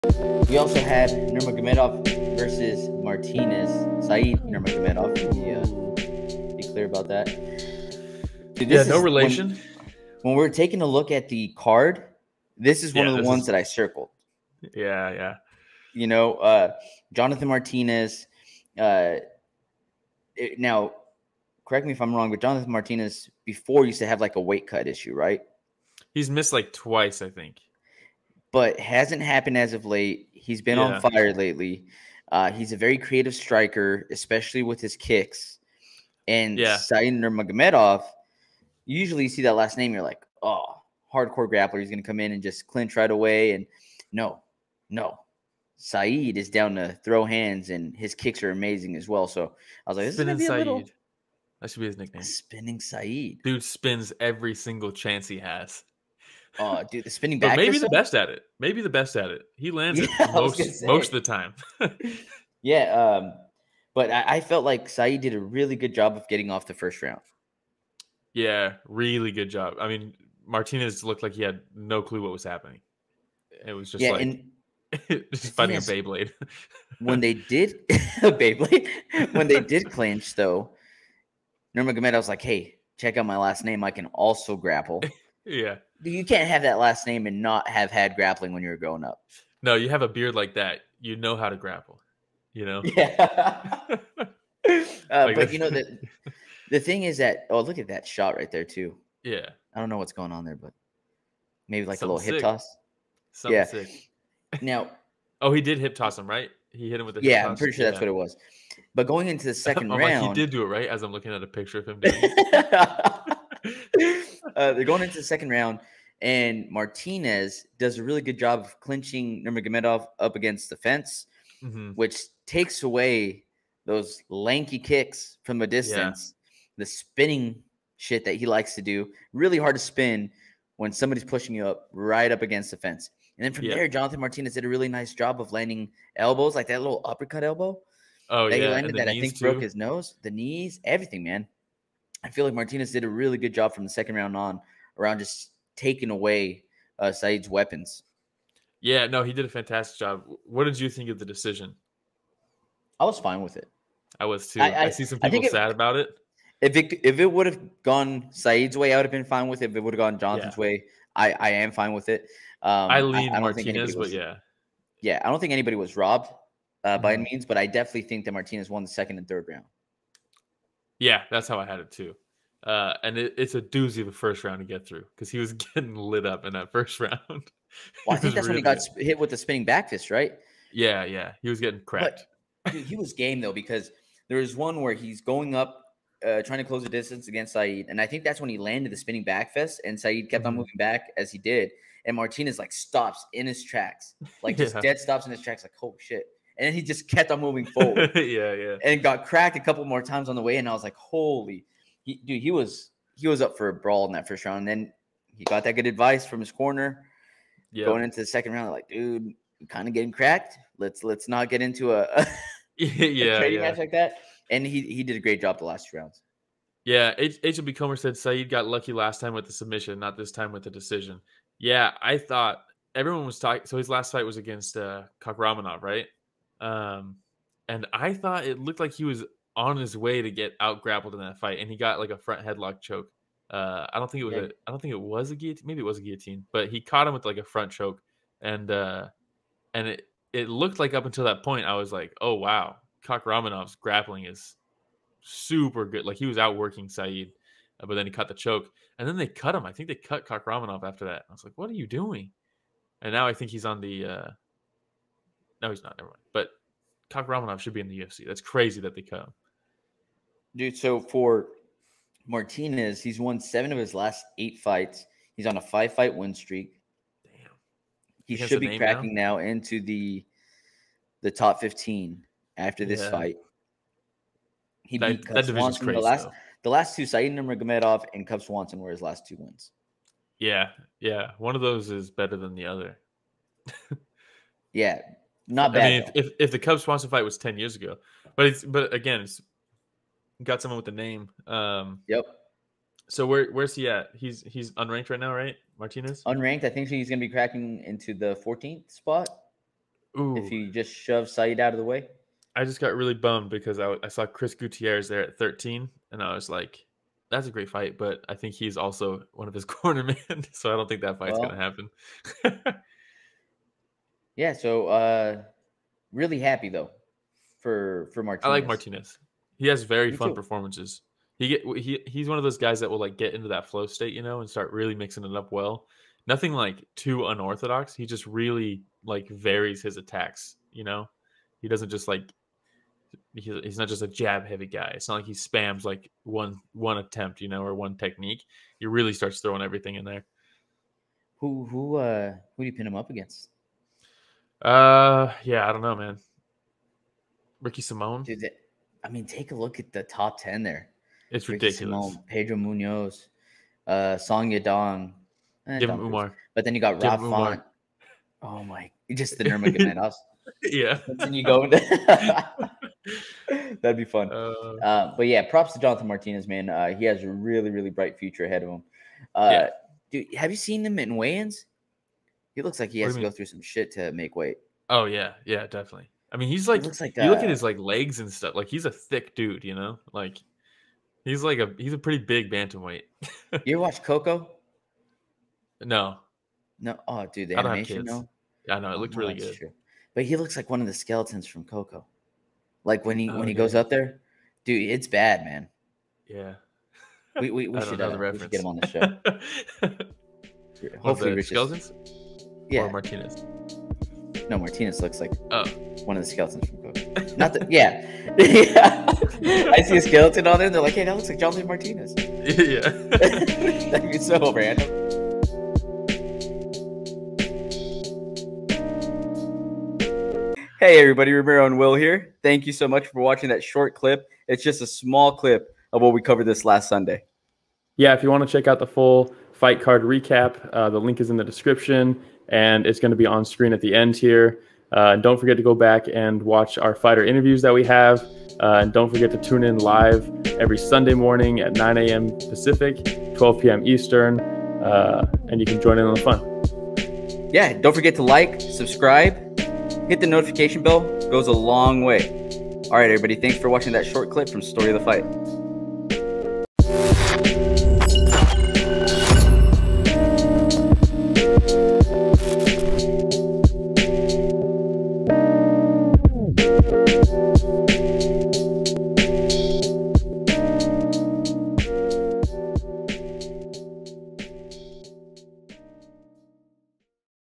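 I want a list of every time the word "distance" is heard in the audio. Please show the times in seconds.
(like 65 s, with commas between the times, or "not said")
125 s, 186 s.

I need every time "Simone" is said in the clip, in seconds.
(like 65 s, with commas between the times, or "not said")
347 s, 352 s.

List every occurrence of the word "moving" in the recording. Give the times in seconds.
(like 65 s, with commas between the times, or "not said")
190 s, 197 s.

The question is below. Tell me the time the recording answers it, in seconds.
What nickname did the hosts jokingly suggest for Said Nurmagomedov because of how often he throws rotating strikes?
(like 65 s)
52 s.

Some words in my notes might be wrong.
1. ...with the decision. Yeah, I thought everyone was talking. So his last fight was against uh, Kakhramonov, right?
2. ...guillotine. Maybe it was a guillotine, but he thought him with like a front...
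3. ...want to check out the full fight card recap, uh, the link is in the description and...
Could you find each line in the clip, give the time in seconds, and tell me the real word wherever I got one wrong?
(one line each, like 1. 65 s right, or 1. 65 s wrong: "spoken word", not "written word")
1. 220 s right
2. 235 s wrong: "caught", not "thought"
3. 428 s right.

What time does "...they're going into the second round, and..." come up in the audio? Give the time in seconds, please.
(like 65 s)
114 s.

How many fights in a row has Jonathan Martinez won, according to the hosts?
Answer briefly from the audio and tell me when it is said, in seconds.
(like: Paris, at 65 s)
5, at 265 s.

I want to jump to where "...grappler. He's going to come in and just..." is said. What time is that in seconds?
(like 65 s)
41 s.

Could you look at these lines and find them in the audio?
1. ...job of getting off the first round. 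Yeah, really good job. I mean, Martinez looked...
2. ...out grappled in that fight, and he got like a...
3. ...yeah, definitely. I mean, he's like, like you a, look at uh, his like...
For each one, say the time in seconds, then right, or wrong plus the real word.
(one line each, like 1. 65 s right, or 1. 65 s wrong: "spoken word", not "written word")
1. 65 s right
2. 230 s right
3. 375 s right.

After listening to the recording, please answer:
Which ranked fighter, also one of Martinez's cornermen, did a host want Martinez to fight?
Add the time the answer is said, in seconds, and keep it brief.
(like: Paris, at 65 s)
Chris Gutierrez, at 304 s.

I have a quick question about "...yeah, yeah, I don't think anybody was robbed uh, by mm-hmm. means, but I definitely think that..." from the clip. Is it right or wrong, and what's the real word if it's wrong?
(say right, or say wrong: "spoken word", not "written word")
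right.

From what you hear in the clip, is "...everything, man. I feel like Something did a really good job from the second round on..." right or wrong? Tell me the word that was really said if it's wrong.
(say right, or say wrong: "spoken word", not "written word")
wrong: "Martinez", not "Something".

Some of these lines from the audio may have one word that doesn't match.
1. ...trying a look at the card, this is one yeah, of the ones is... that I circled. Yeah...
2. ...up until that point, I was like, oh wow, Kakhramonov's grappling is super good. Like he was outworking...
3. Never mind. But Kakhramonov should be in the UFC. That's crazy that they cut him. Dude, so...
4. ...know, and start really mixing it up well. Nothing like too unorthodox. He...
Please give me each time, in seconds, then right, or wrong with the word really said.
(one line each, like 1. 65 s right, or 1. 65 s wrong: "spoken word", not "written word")
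1. 10 s wrong: "taking", not "trying"
2. 240 s right
3. 255 s right
4. 324 s right.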